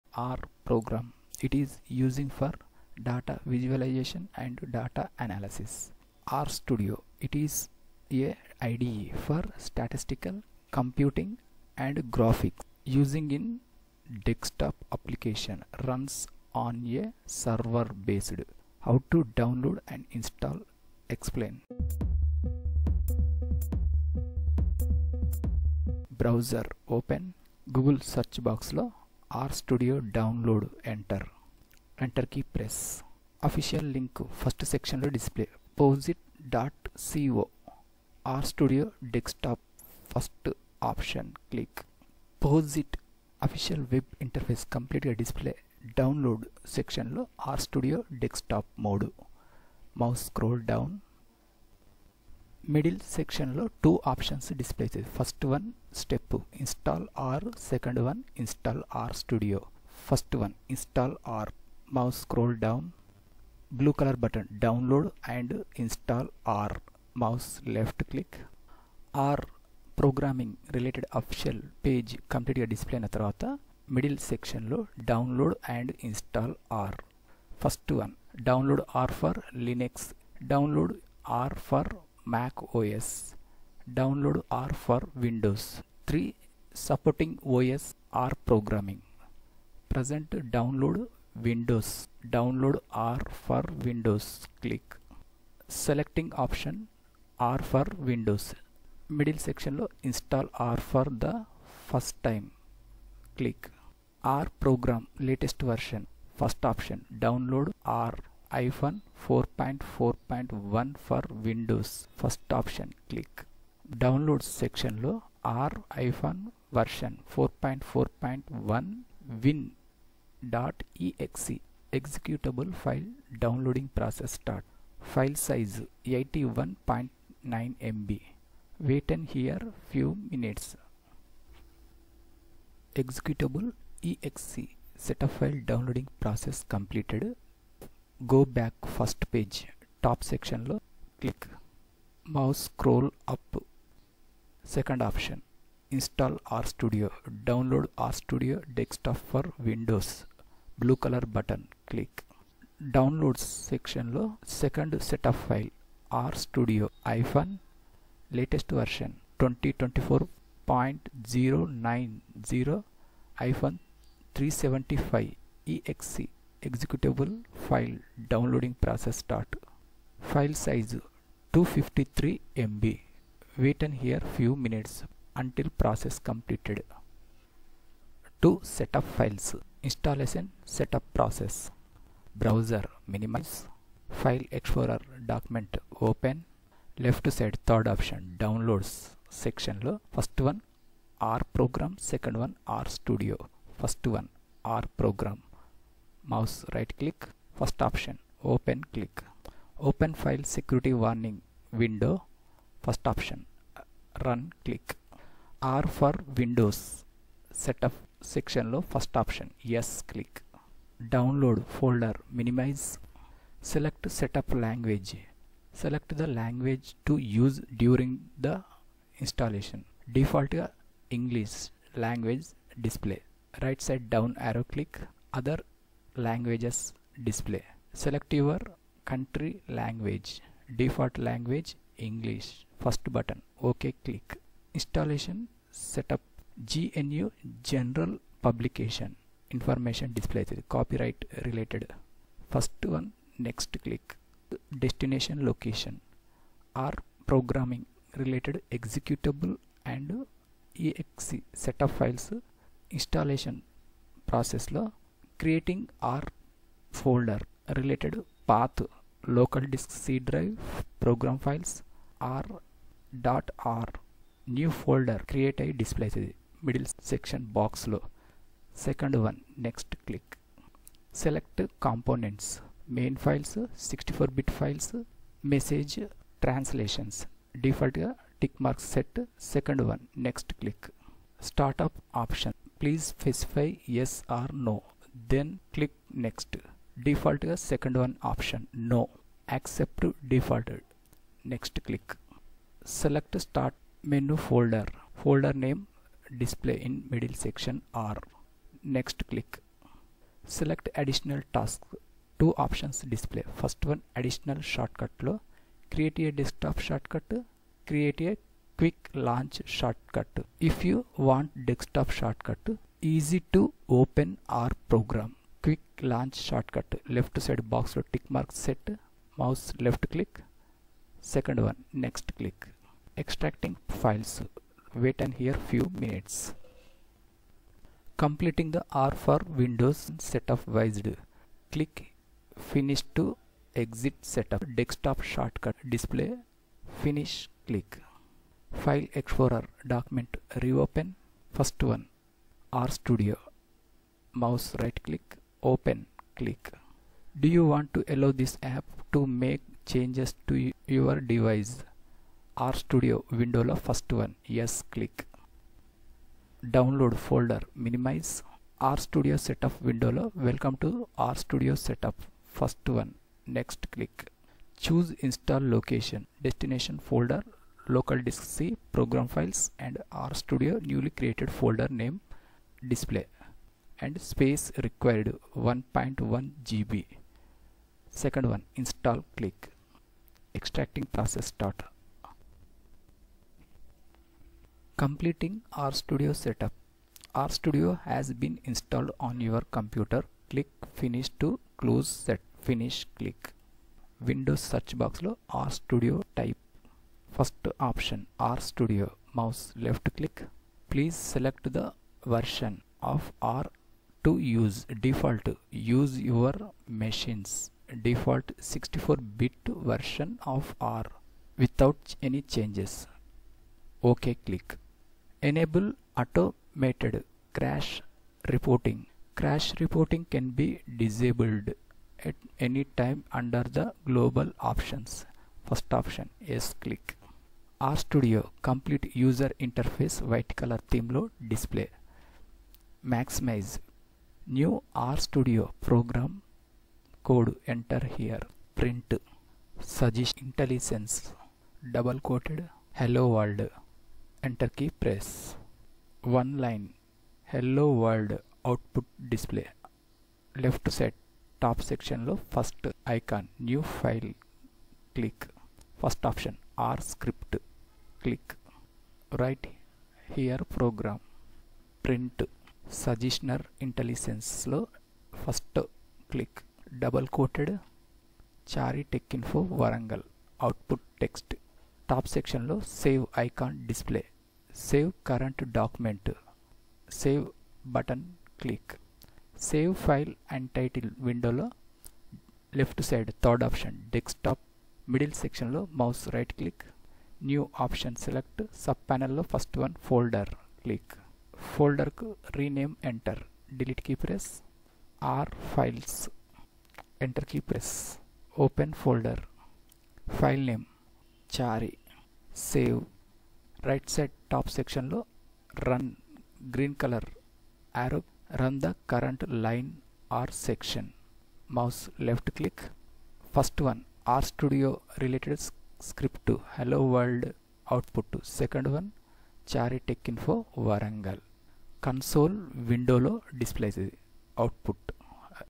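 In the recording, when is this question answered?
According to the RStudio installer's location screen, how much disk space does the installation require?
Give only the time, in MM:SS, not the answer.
06:14.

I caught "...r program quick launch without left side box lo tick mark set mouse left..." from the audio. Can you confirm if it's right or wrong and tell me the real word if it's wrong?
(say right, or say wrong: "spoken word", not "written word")
wrong: "shortcut", not "without".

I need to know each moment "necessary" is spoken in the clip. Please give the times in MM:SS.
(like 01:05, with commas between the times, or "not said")
not said.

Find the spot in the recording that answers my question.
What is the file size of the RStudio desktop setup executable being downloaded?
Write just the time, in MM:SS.
02:50.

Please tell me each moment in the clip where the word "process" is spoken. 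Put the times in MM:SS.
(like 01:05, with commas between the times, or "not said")
02:03, 02:16, 02:48, 02:55, 03:01, 04:14, 06:21.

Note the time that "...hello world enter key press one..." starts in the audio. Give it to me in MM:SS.
07:22.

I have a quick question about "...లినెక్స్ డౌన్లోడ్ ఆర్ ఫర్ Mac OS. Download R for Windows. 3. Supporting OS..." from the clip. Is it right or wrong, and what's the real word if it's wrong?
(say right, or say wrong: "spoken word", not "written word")
right.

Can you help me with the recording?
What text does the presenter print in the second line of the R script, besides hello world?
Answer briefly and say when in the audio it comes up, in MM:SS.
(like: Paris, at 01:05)
Chary Tech Info Warangal, at 07:48.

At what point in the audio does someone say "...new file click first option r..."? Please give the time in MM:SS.
07:33.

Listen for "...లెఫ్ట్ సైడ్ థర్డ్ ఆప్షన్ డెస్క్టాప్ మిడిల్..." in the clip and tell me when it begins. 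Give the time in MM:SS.
08:02.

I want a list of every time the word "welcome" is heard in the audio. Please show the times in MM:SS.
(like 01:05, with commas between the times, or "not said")
06:00.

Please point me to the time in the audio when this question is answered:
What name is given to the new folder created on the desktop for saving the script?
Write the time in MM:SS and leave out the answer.
08:15.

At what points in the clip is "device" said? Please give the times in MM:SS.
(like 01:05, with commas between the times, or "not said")
05:51.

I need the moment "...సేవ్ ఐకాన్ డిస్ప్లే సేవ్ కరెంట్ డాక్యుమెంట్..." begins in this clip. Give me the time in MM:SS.
07:53.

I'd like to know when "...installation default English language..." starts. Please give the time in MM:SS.
03:39.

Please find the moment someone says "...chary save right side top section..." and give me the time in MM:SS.
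08:21.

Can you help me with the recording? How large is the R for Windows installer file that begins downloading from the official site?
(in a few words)
81.9 MB.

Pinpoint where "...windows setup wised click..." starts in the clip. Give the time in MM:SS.
05:29.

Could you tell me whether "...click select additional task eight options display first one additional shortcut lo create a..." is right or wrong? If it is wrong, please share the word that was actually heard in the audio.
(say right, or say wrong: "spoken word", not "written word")
wrong: "two", not "eight".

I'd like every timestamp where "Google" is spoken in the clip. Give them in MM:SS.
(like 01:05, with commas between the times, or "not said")
00:27.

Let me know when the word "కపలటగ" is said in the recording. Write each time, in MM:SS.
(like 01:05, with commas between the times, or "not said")
00:44, 01:12.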